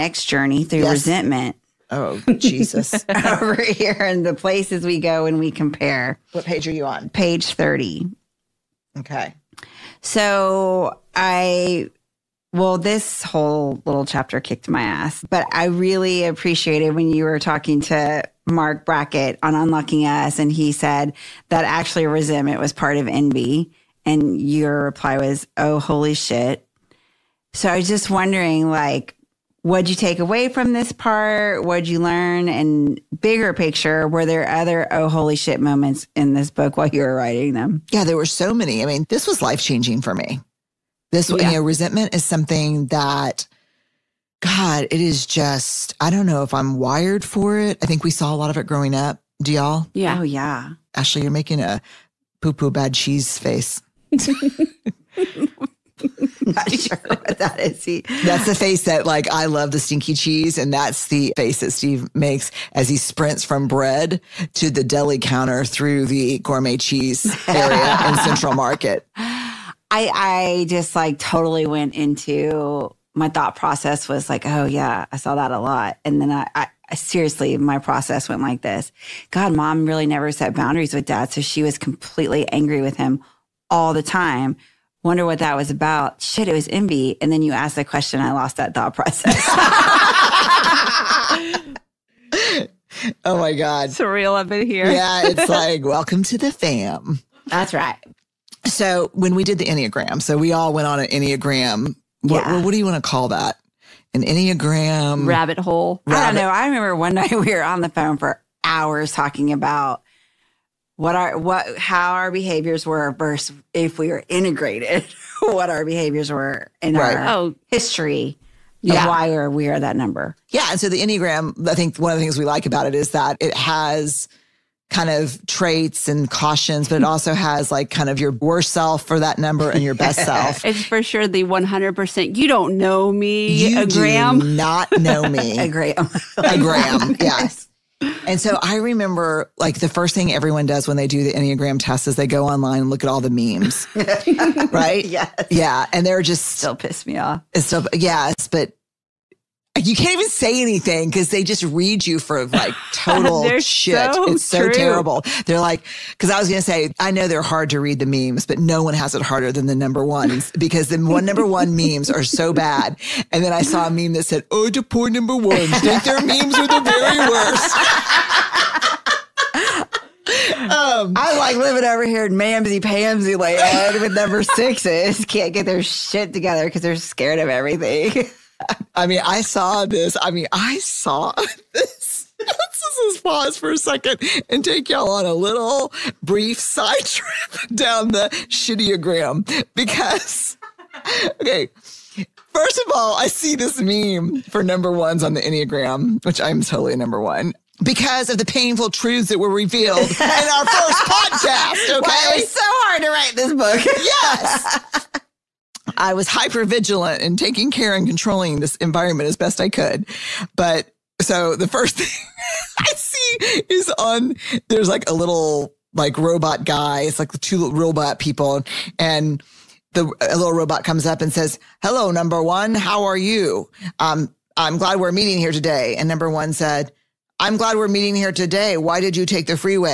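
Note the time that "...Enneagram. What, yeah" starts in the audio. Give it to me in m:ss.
1:41.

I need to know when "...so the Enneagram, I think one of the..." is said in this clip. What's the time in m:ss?
2:00.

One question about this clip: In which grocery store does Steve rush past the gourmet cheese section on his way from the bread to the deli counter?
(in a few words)
Central Market.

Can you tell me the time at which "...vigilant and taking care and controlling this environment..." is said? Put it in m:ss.
3:26.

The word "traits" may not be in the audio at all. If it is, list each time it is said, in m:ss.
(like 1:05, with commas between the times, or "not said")
2:05.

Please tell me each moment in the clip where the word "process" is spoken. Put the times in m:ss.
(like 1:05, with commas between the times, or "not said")
1:13, 1:17, 1:28.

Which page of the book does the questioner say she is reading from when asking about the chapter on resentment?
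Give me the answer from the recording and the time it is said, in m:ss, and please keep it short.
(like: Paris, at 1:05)
30, at 0:07.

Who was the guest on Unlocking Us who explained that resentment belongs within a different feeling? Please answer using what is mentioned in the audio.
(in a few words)
Marc Brackett.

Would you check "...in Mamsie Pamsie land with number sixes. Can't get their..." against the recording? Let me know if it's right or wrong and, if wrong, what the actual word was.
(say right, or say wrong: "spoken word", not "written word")
right.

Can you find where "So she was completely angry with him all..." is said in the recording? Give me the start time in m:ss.
1:21.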